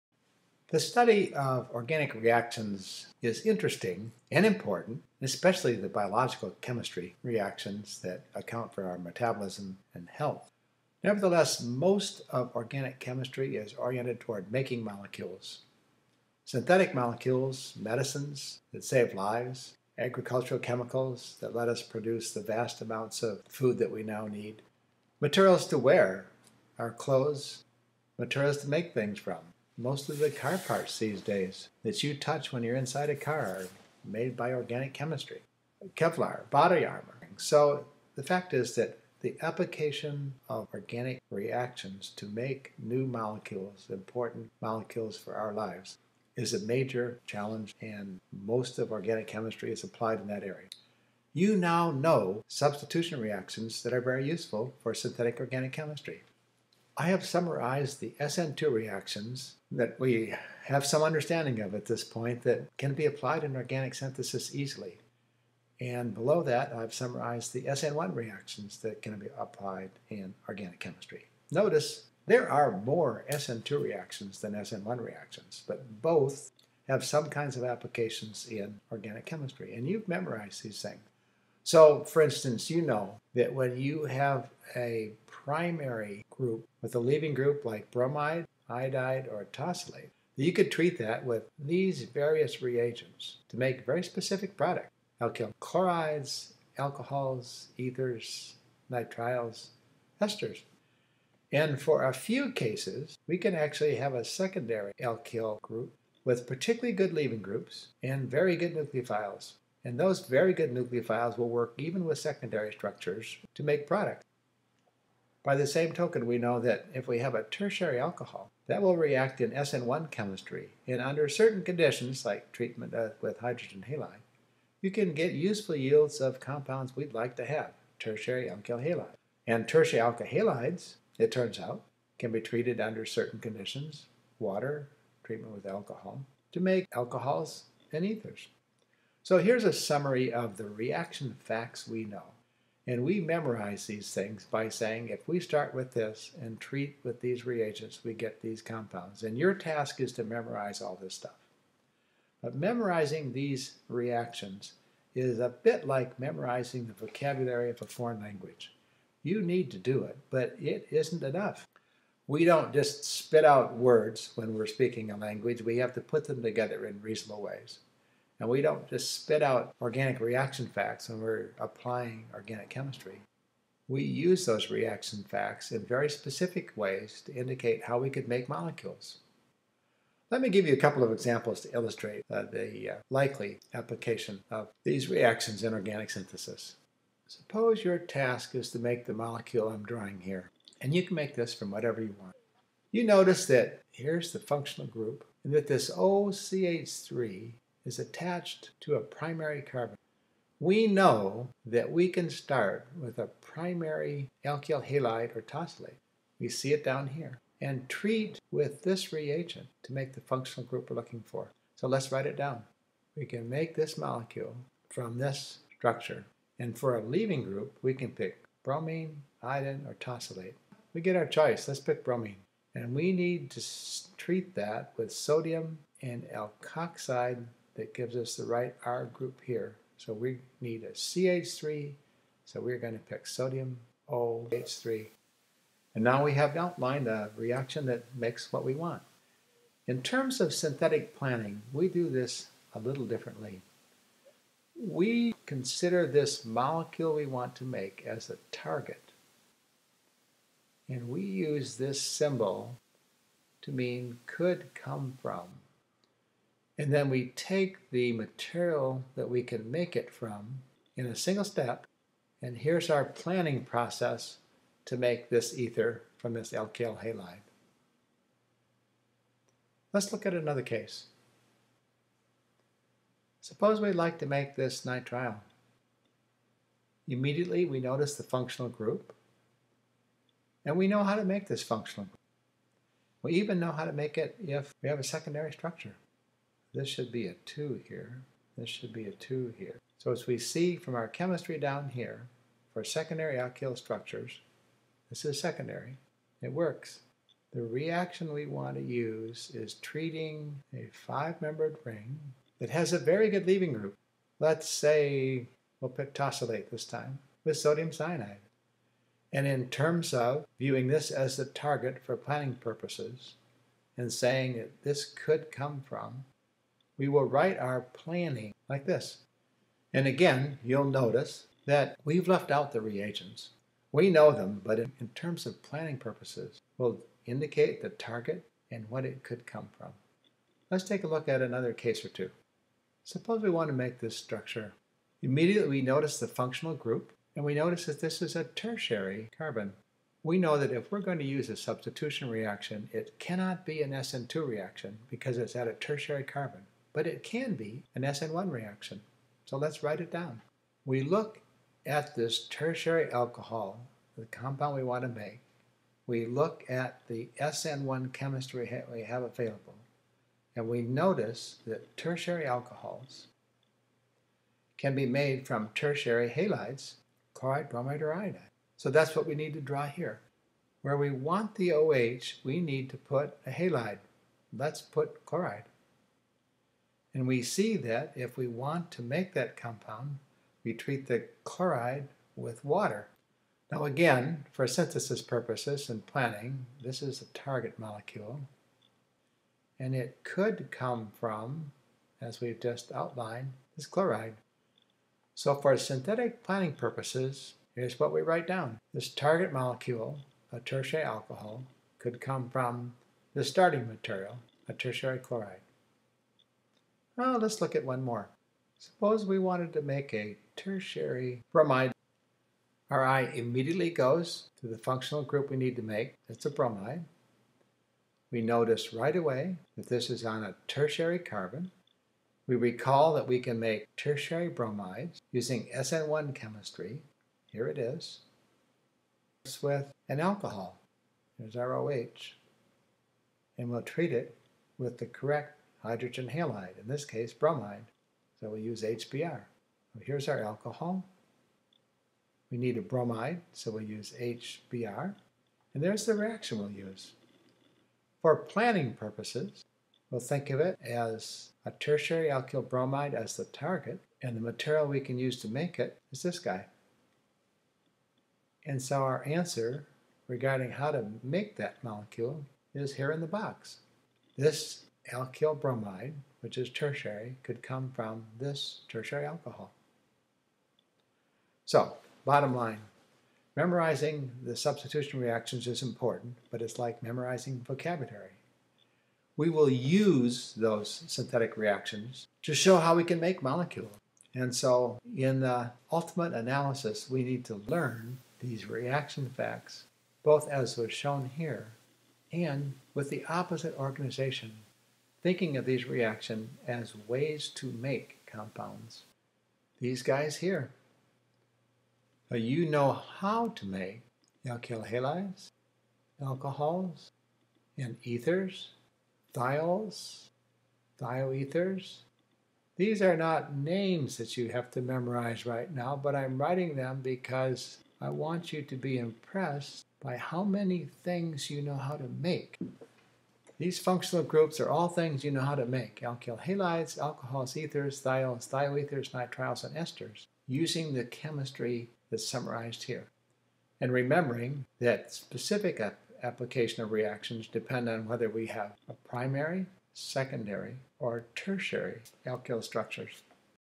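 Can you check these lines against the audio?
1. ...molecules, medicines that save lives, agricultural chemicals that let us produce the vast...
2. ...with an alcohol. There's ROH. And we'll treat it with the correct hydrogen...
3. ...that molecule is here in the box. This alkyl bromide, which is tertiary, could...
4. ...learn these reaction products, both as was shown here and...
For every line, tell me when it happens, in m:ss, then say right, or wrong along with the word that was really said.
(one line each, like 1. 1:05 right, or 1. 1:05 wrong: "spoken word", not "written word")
1. 0:16 right
2. 7:09 right
3. 7:41 right
4. 8:07 wrong: "facts", not "products".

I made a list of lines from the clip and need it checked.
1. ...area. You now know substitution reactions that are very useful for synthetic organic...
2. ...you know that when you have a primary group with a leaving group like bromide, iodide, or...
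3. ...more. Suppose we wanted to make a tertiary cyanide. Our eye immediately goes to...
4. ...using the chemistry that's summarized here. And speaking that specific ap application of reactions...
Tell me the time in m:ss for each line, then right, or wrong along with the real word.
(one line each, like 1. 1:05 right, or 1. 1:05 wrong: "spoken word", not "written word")
1. 0:50 right
2. 1:22 right
3. 6:48 wrong: "bromide", not "cyanide"
4. 8:50 wrong: "remembering", not "speaking".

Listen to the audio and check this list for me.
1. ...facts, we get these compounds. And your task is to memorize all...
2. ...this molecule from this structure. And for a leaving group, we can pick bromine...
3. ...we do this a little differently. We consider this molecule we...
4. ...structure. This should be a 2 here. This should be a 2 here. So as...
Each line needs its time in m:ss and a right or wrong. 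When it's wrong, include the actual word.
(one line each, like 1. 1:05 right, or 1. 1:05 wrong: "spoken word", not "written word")
1. 2:27 wrong: "reagents", not "facts"
2. 3:33 right
3. 4:01 right
4. 4:45 right.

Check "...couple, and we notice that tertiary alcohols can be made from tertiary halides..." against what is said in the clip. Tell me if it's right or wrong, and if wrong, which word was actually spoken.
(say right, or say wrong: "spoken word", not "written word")
wrong: "available", not "couple".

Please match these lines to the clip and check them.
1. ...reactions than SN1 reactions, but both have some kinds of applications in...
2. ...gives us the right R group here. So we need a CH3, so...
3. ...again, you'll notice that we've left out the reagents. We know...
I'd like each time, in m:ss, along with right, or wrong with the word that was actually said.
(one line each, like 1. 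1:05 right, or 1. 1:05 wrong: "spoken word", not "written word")
1. 1:13 right
2. 3:47 right
3. 5:20 right.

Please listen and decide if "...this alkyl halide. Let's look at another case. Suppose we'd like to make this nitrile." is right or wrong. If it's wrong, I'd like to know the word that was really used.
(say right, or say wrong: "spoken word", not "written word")
right.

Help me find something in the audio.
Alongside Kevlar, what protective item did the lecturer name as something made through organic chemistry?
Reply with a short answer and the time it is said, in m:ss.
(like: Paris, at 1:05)
body armor, at 0:36.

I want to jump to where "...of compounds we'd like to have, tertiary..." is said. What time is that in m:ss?
2:06.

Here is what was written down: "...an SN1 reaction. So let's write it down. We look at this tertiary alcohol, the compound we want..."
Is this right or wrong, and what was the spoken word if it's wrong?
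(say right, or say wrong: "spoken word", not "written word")
right.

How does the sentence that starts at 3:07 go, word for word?
Suppose your task is to make the molecule I'm drawing here, and you can make this from whatever you want.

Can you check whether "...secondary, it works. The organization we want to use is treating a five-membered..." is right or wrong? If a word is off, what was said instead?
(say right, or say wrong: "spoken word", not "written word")
wrong: "reaction", not "organization".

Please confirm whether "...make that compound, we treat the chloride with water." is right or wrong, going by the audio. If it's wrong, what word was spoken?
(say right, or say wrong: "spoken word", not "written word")
right.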